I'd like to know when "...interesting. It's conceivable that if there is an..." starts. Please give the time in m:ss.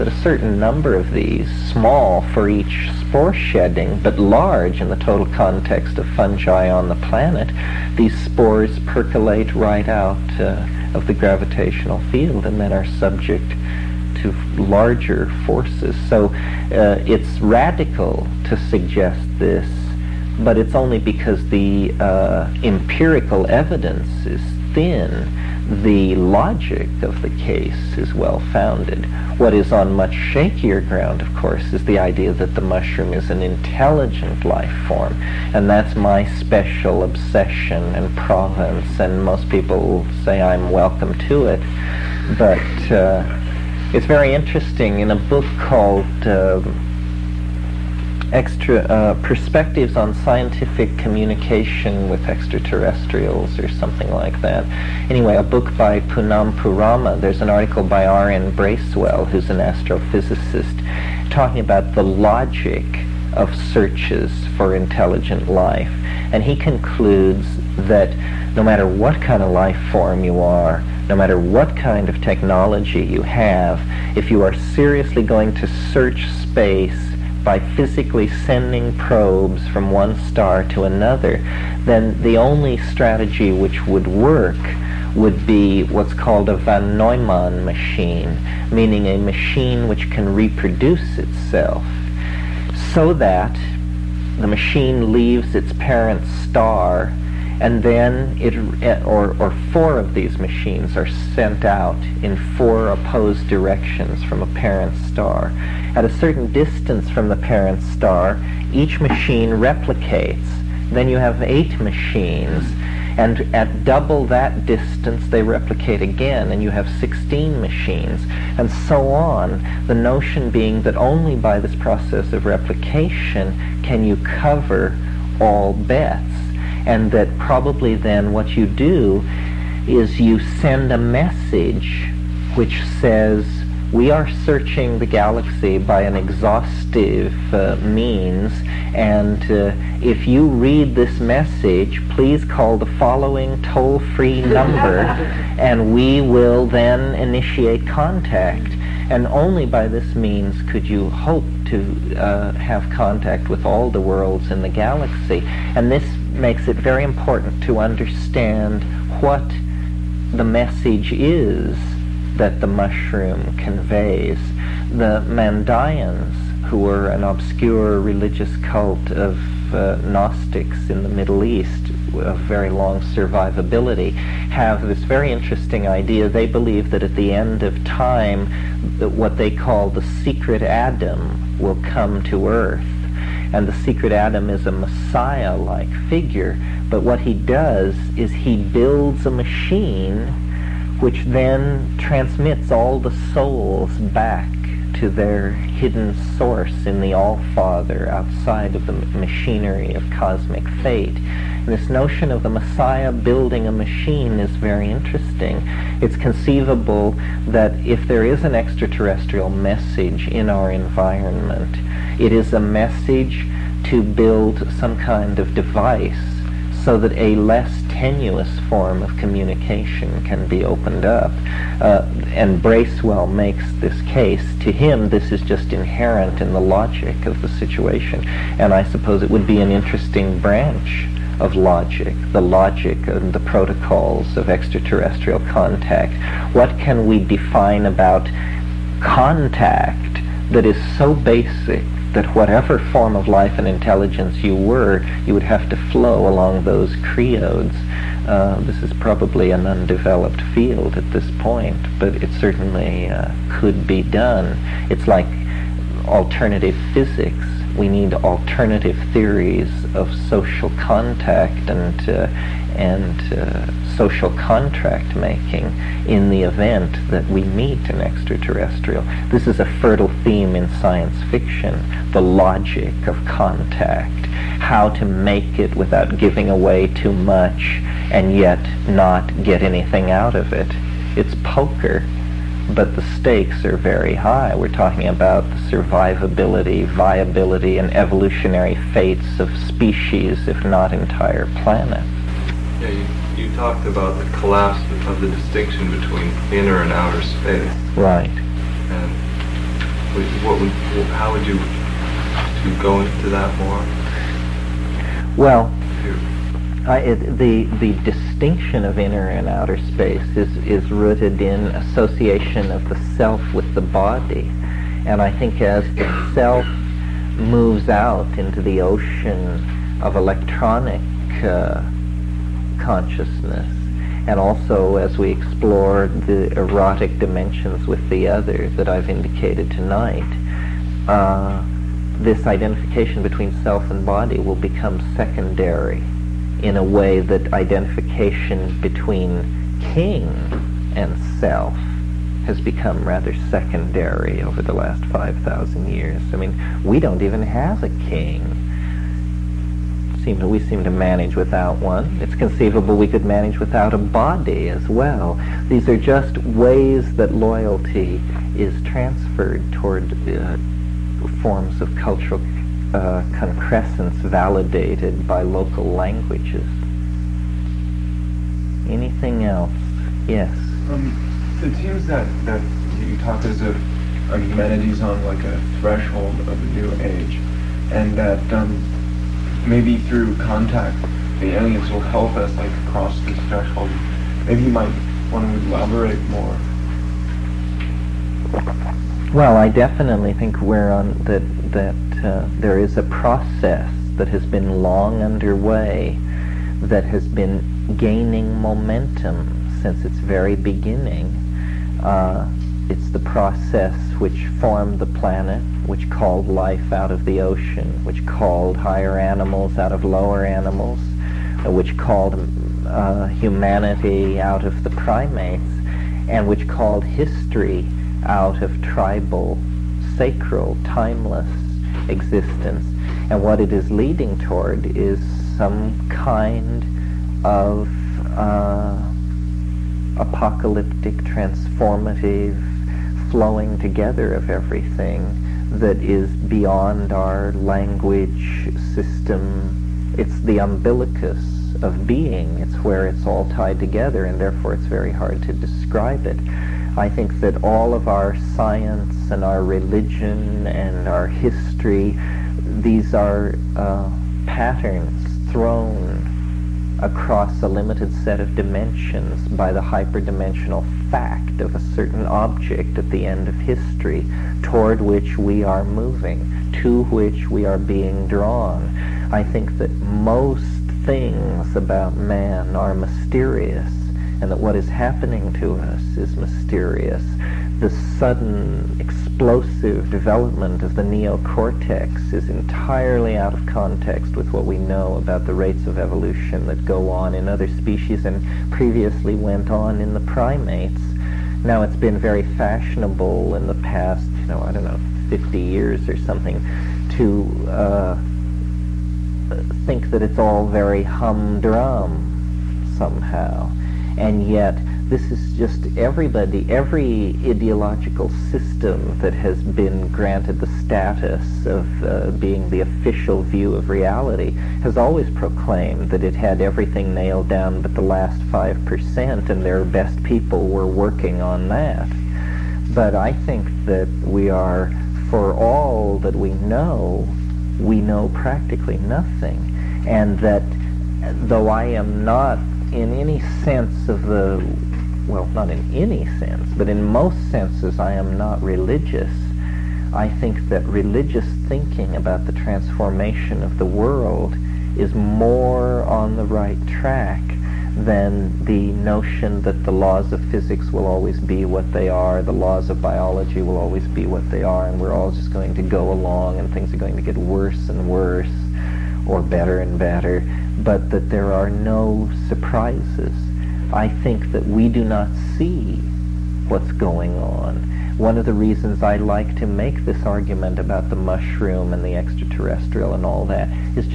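3:24.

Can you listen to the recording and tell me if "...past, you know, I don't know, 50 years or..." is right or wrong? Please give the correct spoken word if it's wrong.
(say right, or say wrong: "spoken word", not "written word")
right.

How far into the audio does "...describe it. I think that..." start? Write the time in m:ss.
7:25.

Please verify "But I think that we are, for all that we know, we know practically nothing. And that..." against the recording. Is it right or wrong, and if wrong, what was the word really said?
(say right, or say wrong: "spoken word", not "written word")
right.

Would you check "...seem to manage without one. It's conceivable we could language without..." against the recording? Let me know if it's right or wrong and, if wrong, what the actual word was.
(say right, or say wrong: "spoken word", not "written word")
wrong: "manage", not "language".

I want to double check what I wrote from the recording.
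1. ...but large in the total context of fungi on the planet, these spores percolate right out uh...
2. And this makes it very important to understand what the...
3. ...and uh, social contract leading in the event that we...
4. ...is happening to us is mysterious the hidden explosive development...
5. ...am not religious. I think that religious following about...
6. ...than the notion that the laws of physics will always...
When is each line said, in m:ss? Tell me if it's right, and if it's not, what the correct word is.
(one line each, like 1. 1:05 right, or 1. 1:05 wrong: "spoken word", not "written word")
1. 0:03 right
2. 2:35 right
3. 4:22 wrong: "making", not "leading"
4. 7:54 wrong: "sudden", not "hidden"
5. 8:58 wrong: "thinking", not "following"
6. 9:07 right.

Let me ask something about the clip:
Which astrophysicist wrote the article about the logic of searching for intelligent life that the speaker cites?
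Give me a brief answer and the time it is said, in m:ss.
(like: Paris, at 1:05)
R.N. Bracewell, at 0:58.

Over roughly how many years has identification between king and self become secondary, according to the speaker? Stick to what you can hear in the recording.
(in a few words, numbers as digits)
5,000.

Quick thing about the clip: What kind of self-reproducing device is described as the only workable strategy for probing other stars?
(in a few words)
von Neumann machine.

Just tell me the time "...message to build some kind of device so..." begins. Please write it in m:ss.
3:32.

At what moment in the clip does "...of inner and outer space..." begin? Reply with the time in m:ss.
5:08.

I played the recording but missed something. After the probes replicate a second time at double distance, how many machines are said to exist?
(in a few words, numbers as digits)
16.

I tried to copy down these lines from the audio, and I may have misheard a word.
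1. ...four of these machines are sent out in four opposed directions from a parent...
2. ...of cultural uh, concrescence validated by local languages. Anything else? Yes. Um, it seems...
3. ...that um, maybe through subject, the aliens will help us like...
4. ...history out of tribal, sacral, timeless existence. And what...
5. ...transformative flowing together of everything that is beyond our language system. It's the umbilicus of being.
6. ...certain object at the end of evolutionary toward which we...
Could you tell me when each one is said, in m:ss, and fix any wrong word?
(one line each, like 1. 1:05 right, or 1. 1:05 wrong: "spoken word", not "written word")
1. 1:39 right
2. 6:01 right
3. 6:18 wrong: "contact", not "subject"
4. 6:57 right
5. 7:11 right
6. 7:41 wrong: "history", not "evolutionary".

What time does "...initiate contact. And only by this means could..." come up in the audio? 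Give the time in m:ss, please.
2:27.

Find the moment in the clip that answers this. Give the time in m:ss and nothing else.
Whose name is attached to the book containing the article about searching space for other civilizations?
0:55.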